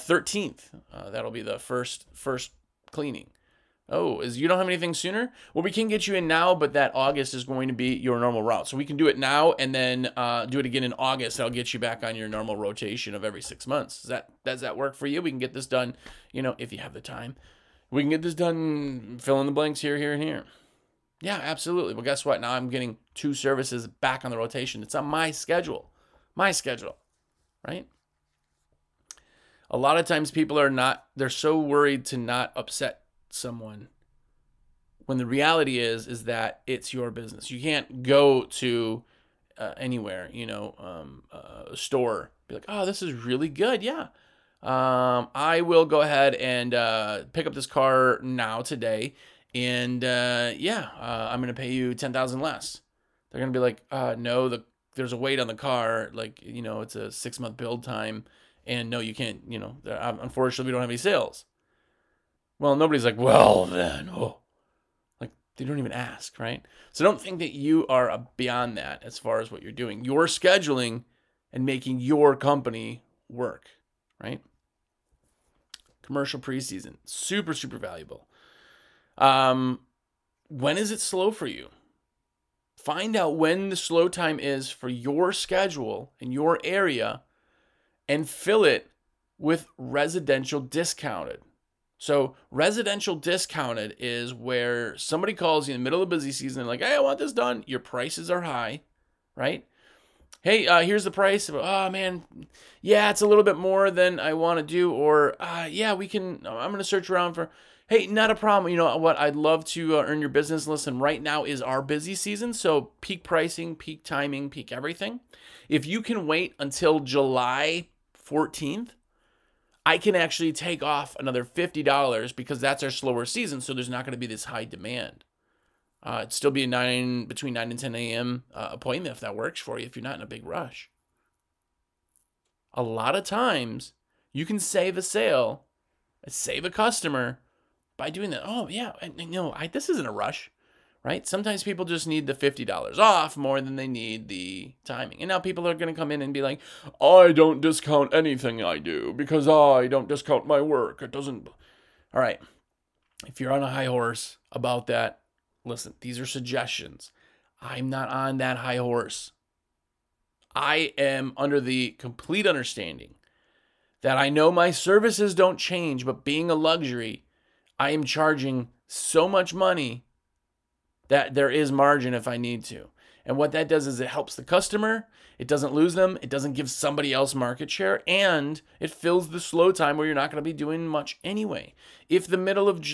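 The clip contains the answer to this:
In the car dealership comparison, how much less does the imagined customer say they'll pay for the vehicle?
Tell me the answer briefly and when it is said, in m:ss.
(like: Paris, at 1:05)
$10,000, at 0:51.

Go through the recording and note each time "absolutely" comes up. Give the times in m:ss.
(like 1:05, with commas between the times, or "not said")
0:21.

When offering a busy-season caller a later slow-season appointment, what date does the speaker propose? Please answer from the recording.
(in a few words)
July 14th.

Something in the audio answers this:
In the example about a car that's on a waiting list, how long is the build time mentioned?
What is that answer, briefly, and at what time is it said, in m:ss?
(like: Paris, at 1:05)
6 months, at 0:57.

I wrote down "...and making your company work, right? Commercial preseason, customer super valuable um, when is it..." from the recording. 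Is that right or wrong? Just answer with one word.
wrong.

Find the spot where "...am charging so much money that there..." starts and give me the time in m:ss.
2:47.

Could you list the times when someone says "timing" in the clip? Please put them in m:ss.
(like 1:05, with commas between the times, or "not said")
1:54, 2:24.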